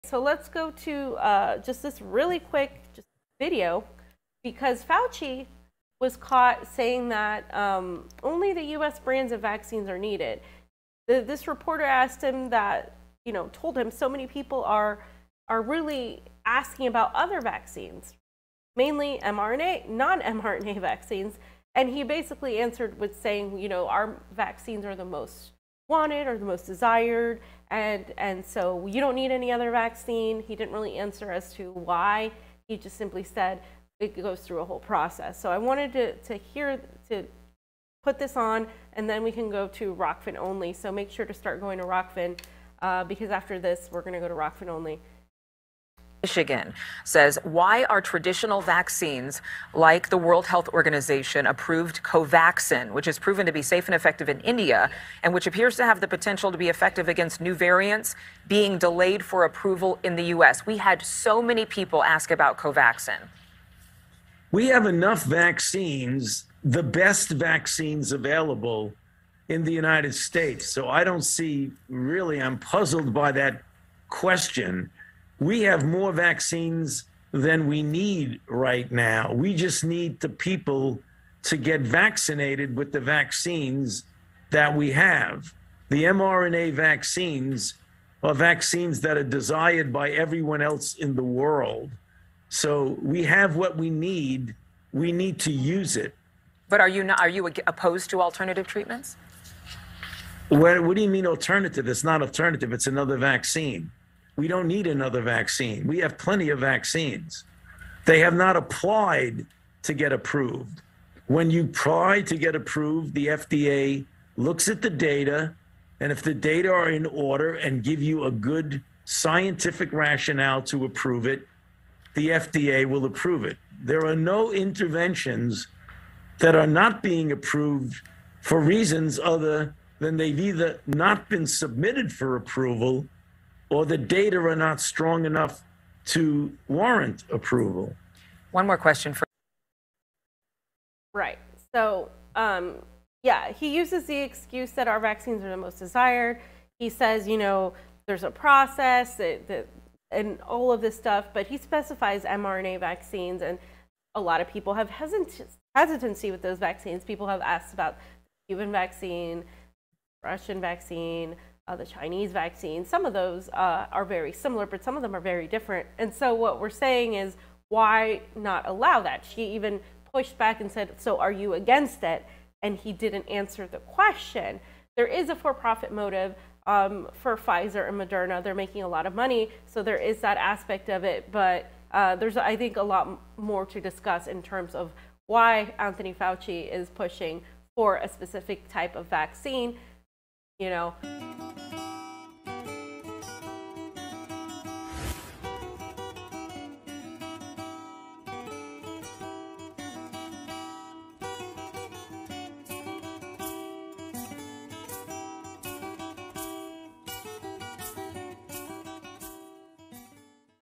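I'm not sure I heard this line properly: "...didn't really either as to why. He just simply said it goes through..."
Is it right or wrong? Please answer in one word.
wrong.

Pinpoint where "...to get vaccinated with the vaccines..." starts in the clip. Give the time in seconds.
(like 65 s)
81 s.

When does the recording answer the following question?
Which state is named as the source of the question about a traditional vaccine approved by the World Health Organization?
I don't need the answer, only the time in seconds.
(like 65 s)
46 s.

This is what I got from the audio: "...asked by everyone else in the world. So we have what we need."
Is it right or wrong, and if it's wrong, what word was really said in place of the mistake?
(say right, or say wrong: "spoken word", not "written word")
wrong: "desired", not "asked".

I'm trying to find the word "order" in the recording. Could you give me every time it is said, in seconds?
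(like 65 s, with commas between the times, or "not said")
117 s.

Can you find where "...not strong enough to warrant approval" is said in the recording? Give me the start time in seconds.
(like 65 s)
134 s.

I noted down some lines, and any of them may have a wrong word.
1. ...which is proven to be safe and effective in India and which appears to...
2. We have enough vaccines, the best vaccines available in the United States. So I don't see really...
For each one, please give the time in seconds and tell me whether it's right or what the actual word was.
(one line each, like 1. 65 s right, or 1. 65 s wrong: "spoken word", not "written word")
1. 52 s right
2. 64 s right.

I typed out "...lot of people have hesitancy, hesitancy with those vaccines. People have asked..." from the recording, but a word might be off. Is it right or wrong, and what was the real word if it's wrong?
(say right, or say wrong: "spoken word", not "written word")
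right.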